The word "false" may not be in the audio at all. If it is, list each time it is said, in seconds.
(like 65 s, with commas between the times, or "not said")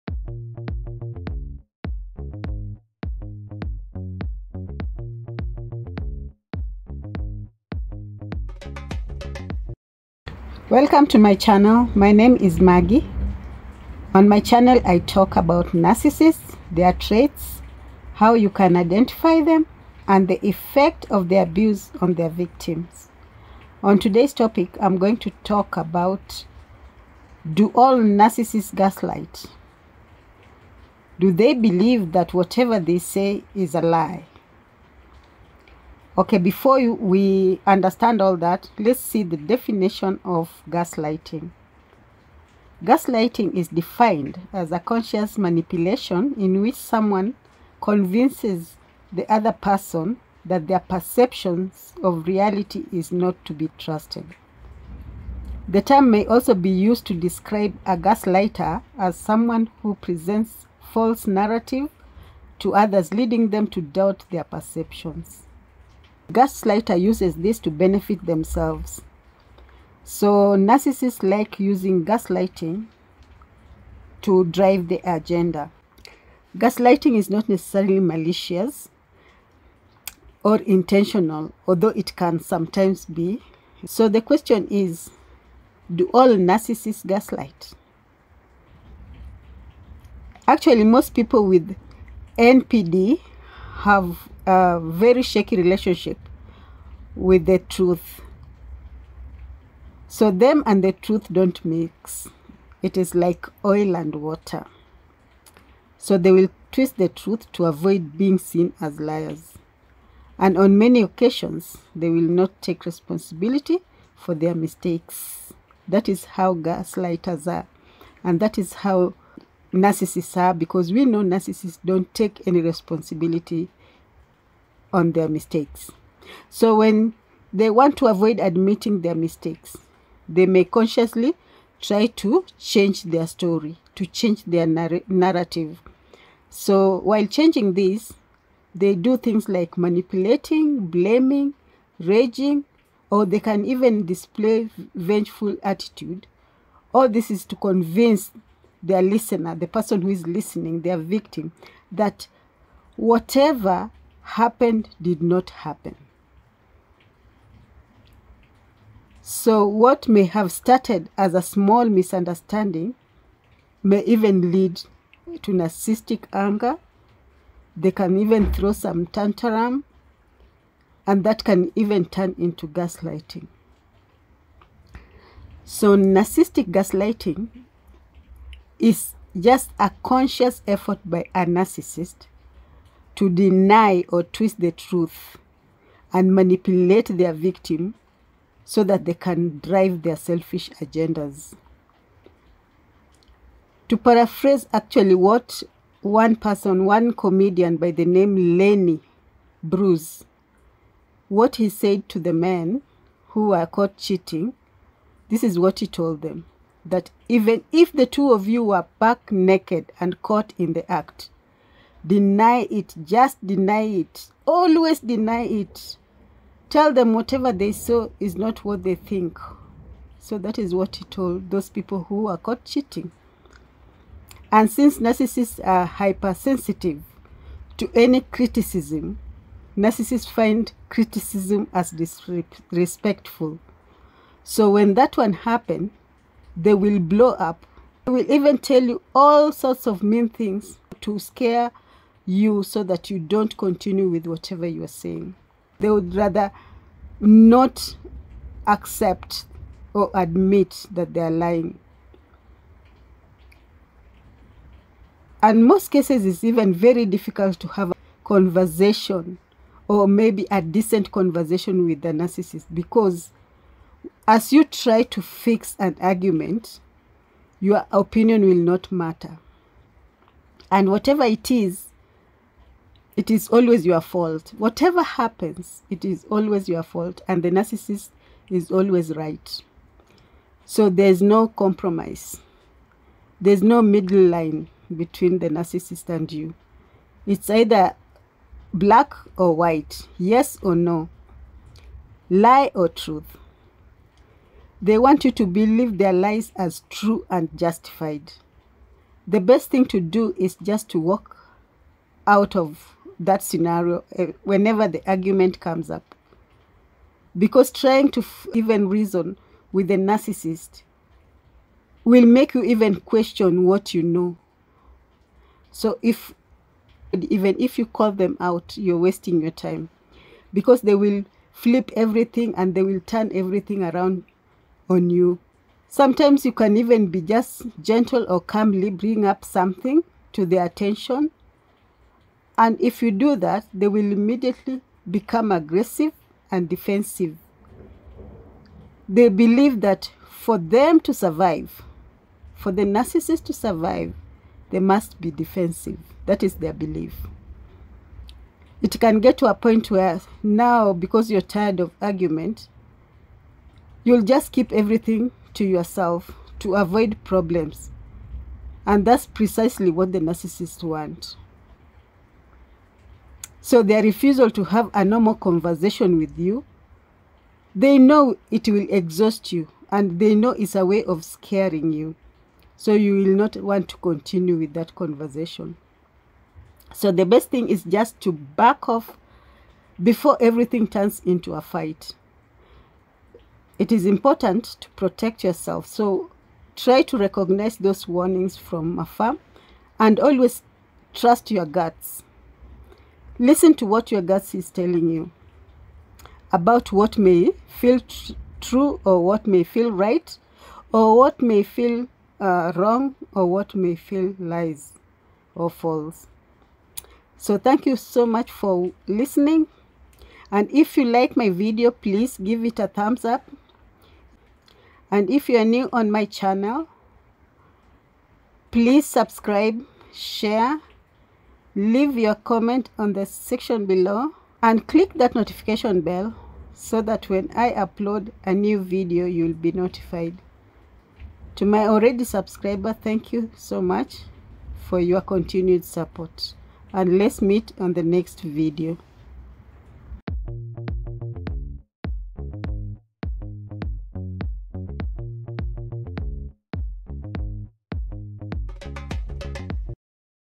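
60 s, 405 s.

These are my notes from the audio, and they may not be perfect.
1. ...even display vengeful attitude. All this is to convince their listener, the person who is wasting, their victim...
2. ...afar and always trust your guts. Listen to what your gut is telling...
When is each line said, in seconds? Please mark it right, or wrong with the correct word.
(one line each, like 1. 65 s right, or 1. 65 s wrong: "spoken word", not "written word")
1. 143 s wrong: "listening", not "wasting"
2. 388 s right.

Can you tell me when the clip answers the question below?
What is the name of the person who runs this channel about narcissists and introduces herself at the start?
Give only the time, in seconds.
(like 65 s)
12 s.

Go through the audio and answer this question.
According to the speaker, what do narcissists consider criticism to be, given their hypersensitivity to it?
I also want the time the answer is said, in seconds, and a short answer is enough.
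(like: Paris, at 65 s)
disrespectful, at 231 s.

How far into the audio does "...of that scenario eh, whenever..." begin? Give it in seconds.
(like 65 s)
302 s.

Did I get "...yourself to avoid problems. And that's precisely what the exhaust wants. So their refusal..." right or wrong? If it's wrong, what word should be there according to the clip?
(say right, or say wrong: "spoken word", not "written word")
wrong: "narcissist", not "exhaust".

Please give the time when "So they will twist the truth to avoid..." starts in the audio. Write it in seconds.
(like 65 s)
105 s.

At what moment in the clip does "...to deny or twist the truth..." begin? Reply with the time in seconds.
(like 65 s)
183 s.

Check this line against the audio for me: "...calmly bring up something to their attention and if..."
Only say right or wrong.
right.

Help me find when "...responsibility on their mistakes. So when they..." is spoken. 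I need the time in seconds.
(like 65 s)
122 s.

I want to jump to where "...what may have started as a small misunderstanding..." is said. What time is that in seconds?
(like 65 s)
159 s.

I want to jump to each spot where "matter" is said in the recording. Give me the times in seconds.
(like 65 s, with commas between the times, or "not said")
268 s.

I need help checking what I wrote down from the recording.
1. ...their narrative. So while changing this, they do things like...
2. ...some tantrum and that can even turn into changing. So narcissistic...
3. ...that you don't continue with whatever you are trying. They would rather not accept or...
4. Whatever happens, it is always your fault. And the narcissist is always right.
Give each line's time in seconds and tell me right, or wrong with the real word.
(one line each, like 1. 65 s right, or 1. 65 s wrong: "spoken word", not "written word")
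1. 134 s right
2. 168 s wrong: "gaslighting", not "changing"
3. 242 s wrong: "saying", not "trying"
4. 274 s right.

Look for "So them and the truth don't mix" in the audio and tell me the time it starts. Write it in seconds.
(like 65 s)
100 s.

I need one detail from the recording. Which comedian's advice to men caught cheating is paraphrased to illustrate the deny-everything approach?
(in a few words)
Lenny Bruce.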